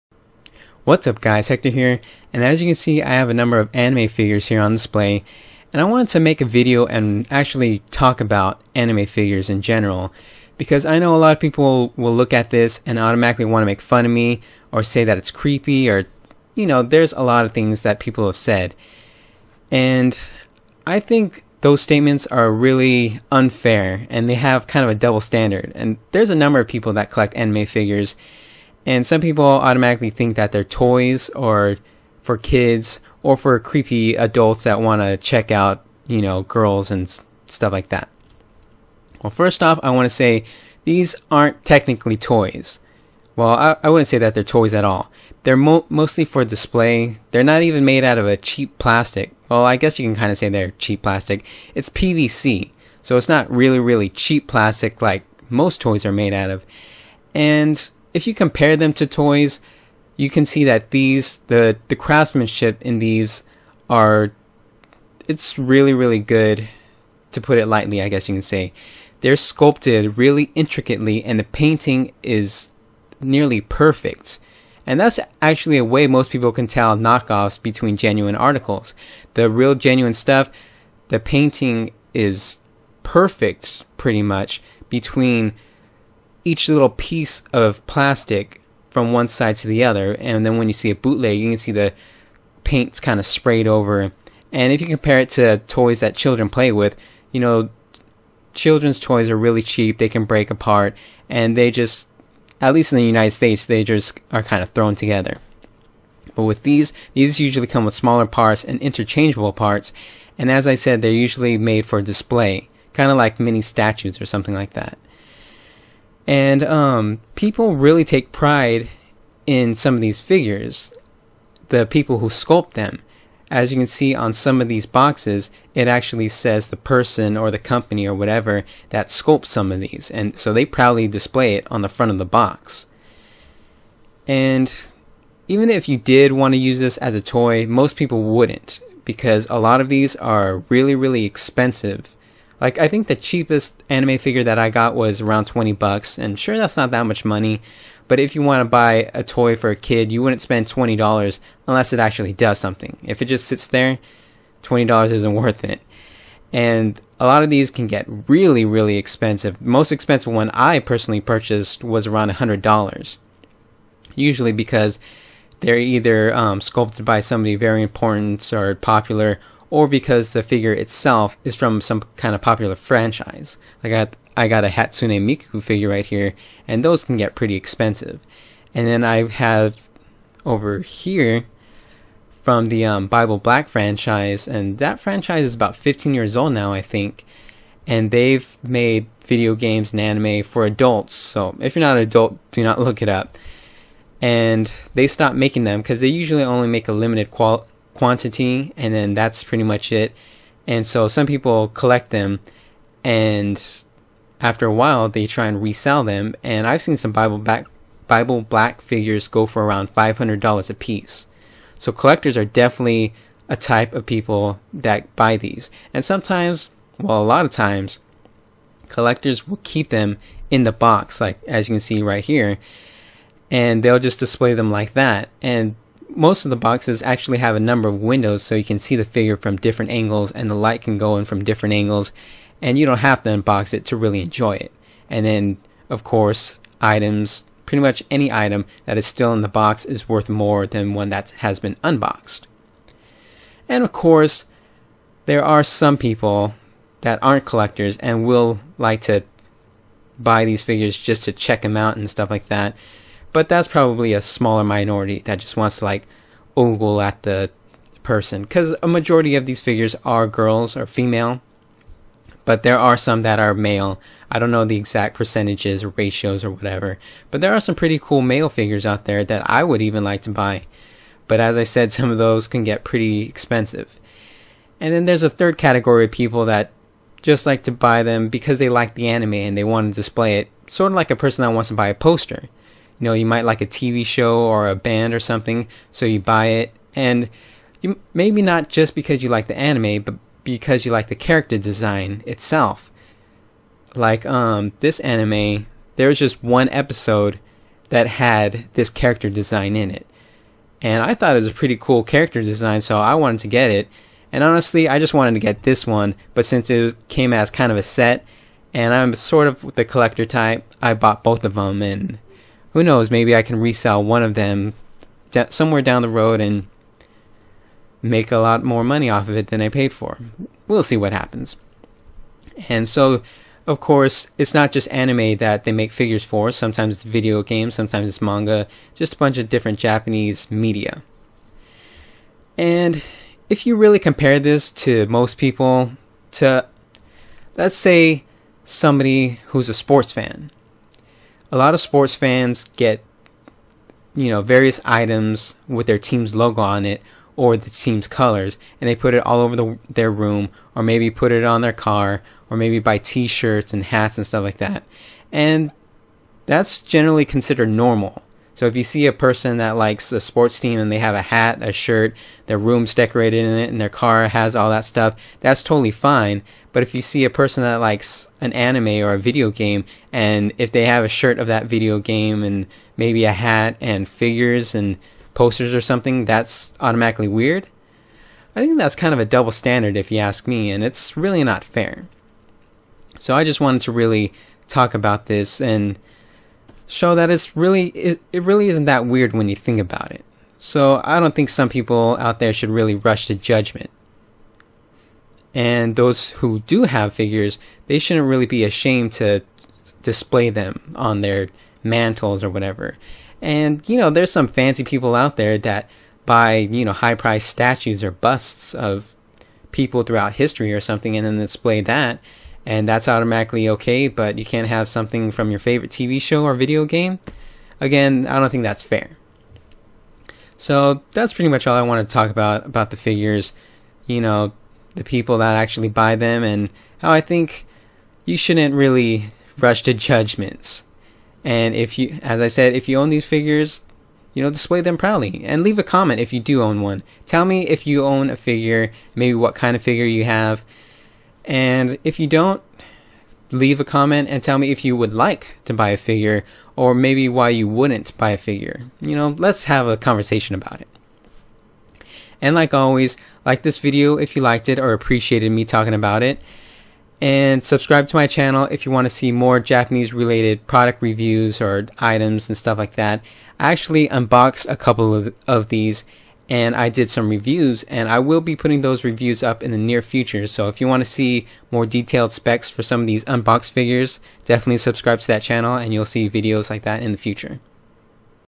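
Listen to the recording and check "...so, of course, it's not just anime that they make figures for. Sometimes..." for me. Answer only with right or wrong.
right.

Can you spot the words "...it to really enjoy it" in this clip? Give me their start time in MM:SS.
03:53.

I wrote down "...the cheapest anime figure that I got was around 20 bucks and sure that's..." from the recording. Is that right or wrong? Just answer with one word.
right.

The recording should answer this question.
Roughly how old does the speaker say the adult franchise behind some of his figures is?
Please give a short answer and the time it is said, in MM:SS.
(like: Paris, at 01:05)
15 years, at 03:05.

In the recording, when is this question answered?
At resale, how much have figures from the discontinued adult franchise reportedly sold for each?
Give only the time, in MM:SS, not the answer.
03:29.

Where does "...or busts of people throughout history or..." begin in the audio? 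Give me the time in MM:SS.
06:48.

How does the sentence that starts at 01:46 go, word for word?
But with these, these usually come with smaller parts and interchangeable parts.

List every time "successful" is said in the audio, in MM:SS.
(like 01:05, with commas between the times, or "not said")
not said.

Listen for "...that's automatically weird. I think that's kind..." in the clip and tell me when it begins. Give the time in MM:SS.
06:16.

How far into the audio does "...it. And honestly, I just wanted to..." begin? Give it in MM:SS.
05:03.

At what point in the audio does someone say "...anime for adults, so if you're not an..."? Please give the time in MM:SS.
03:10.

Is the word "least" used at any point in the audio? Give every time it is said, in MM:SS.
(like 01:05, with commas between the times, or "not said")
01:42.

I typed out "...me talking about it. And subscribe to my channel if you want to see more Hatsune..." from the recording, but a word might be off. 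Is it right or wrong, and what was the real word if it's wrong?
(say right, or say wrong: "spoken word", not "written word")
wrong: "Japanese", not "Hatsune".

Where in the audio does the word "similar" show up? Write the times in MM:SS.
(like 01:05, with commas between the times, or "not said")
not said.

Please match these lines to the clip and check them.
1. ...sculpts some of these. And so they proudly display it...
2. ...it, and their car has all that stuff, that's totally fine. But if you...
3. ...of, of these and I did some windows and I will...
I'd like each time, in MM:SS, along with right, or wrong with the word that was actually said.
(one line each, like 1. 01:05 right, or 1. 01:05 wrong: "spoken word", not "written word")
1. 02:09 right
2. 06:03 right
3. 07:45 wrong: "reviews", not "windows".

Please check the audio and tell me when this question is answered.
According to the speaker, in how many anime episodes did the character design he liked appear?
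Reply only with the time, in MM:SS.
04:56.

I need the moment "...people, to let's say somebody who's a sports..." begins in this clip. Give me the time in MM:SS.
05:35.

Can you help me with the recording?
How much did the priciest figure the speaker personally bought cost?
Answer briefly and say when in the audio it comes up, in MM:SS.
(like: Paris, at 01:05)
$100, at 02:42.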